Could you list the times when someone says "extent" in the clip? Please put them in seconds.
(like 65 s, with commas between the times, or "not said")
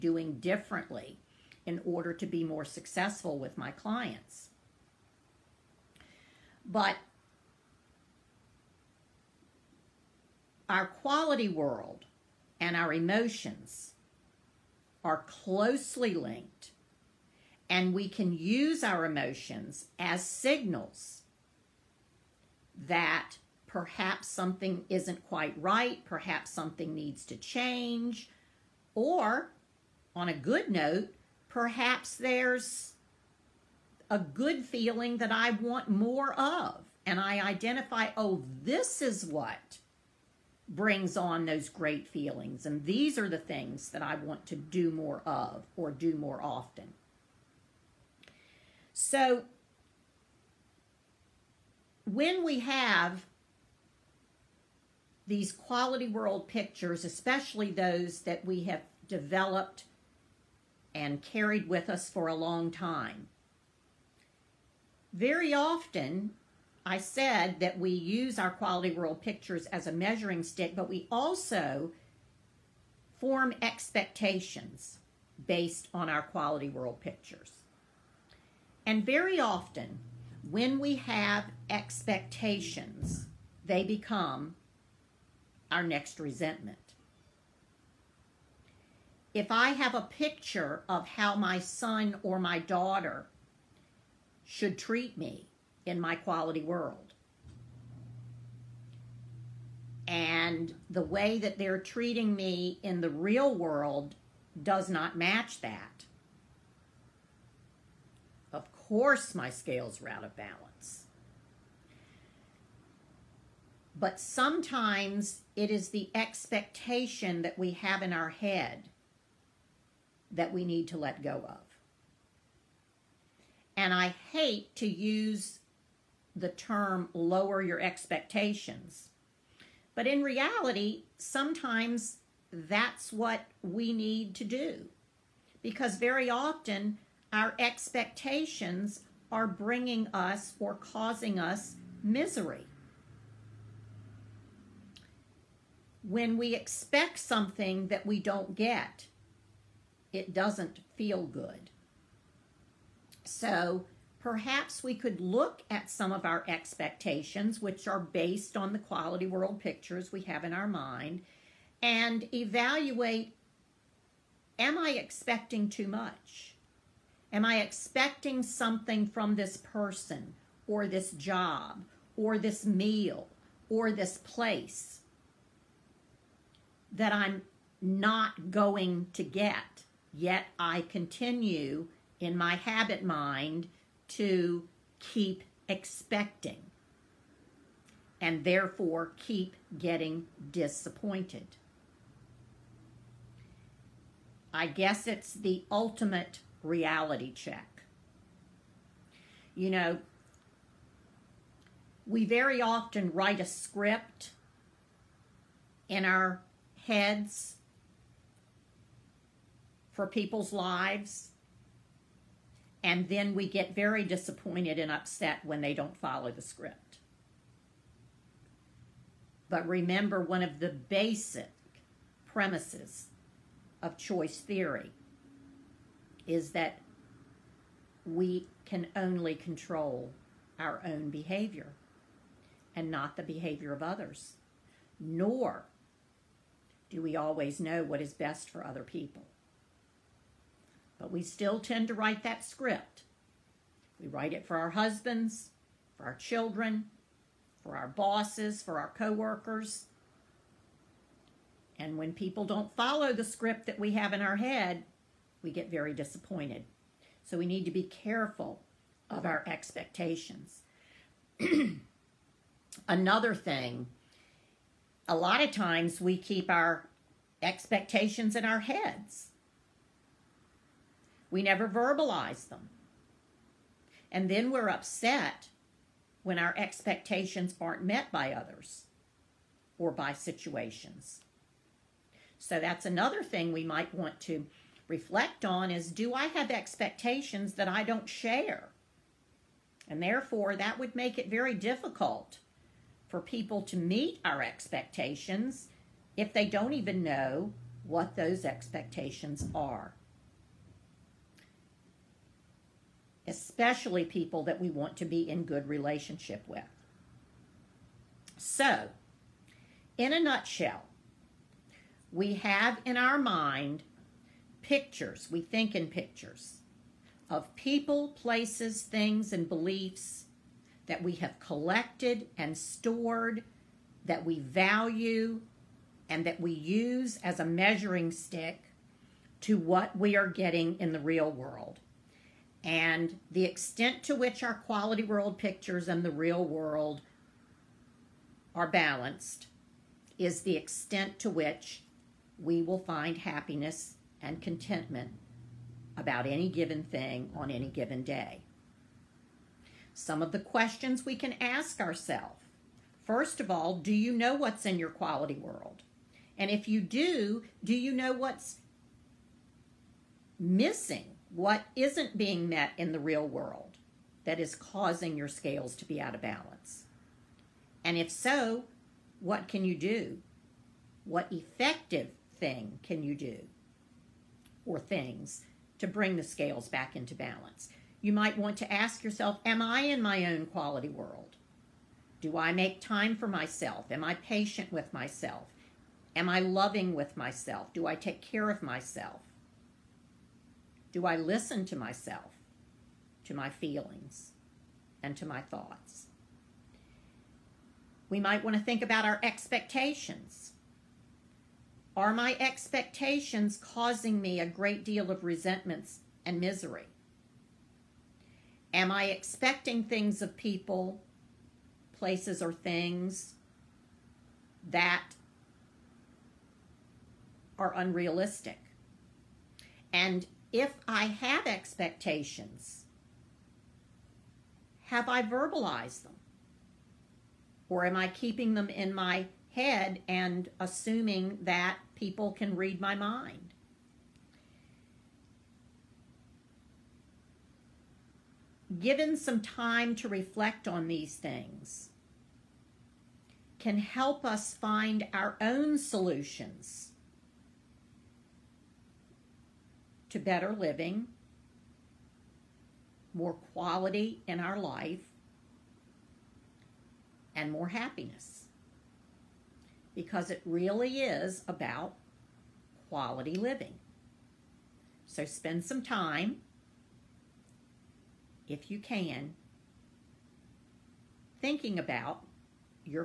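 333 s, 340 s.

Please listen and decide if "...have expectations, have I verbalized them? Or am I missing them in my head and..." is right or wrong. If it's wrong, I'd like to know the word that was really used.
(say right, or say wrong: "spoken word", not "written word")
wrong: "keeping", not "missing".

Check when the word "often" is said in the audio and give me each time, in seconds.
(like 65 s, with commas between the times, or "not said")
46 s, 65 s, 79 s, 136 s, 202 s.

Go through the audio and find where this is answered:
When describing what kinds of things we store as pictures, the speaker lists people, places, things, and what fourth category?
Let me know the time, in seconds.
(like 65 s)
319 s.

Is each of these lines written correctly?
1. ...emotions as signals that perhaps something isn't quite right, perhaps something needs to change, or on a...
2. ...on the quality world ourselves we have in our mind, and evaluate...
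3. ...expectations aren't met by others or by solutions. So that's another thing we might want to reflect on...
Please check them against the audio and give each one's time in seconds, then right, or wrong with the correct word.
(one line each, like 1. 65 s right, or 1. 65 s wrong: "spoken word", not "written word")
1. 19 s right
2. 158 s wrong: "pictures", not "ourselves"
3. 276 s wrong: "situations", not "solutions".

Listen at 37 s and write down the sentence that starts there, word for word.
And I identify, oh, this is what brings on those great feelings.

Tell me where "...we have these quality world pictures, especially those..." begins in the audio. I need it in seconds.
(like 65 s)
52 s.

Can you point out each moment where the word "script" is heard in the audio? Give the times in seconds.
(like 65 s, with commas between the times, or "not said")
203 s, 216 s, 242 s, 253 s.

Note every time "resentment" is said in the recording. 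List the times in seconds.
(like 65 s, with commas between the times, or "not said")
86 s, 405 s.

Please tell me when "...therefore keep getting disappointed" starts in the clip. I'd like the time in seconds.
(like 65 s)
188 s.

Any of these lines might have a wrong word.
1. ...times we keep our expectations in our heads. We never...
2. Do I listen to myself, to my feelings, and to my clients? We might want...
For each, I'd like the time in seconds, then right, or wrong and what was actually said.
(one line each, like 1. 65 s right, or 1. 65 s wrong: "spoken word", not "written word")
1. 265 s right
2. 390 s wrong: "thoughts", not "clients".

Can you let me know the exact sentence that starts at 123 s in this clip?
And I hate to use the term lower your expectations.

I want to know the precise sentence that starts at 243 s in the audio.
We write it for our husbands, for our children, for our bosses, for our coworkers.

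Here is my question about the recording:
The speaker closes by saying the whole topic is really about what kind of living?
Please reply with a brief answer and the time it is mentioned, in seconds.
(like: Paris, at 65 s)
quality living, at 462 s.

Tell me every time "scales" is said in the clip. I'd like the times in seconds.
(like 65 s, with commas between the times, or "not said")
109 s, 365 s, 376 s.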